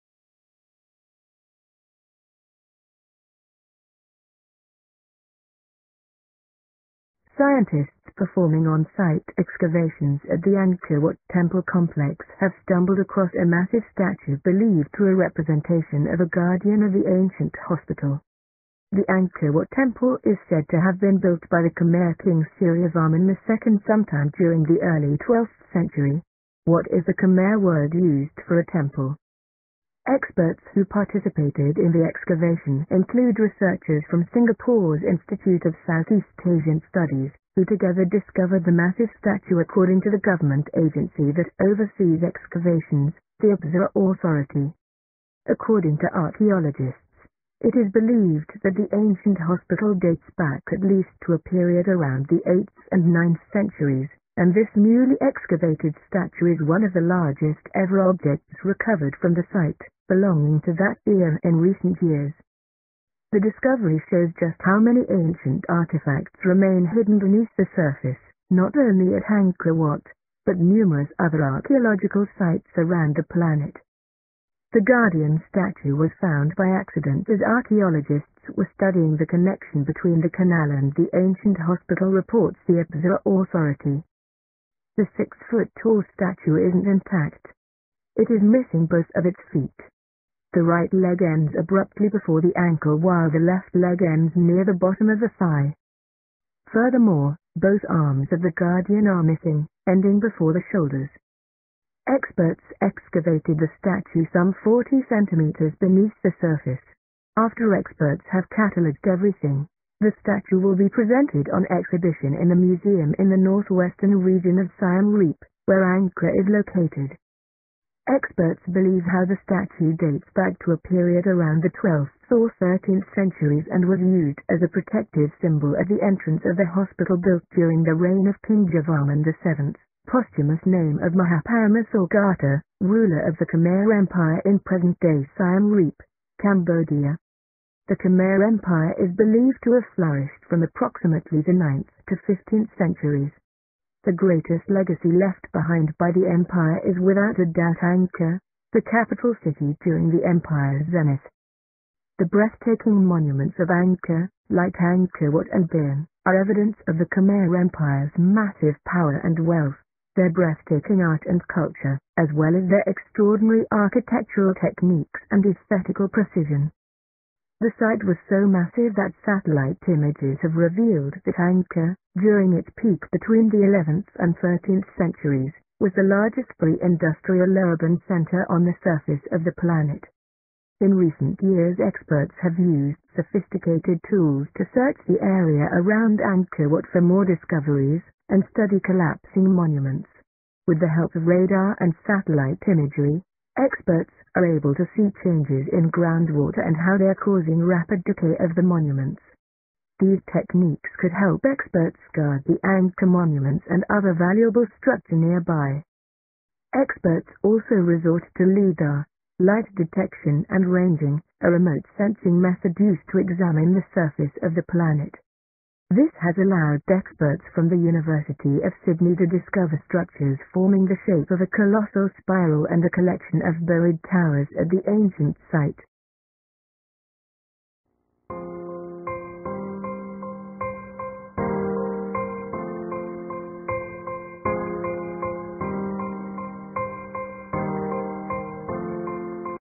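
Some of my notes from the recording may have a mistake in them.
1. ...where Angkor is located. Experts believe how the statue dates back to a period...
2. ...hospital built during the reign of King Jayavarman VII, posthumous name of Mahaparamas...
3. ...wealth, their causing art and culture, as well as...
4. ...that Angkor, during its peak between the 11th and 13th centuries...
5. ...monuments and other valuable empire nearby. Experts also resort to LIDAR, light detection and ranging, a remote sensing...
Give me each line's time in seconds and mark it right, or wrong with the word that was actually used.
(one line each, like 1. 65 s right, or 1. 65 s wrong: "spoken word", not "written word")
1. 115 s right
2. 126 s right
3. 159 s wrong: "breathtaking", not "causing"
4. 171 s right
5. 203 s wrong: "structure", not "empire".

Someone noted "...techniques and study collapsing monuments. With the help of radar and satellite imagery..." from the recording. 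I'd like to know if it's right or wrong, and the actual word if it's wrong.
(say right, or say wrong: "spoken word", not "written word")
wrong: "discoveries", not "techniques".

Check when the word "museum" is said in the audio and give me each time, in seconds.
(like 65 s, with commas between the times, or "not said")
112 s.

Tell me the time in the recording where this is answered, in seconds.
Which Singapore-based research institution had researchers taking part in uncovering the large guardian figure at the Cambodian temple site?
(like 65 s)
35 s.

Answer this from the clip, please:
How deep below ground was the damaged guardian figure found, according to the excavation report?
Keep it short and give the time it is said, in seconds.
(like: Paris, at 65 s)
40 centimeters, at 104 s.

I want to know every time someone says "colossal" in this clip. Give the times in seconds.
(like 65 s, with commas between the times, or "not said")
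221 s.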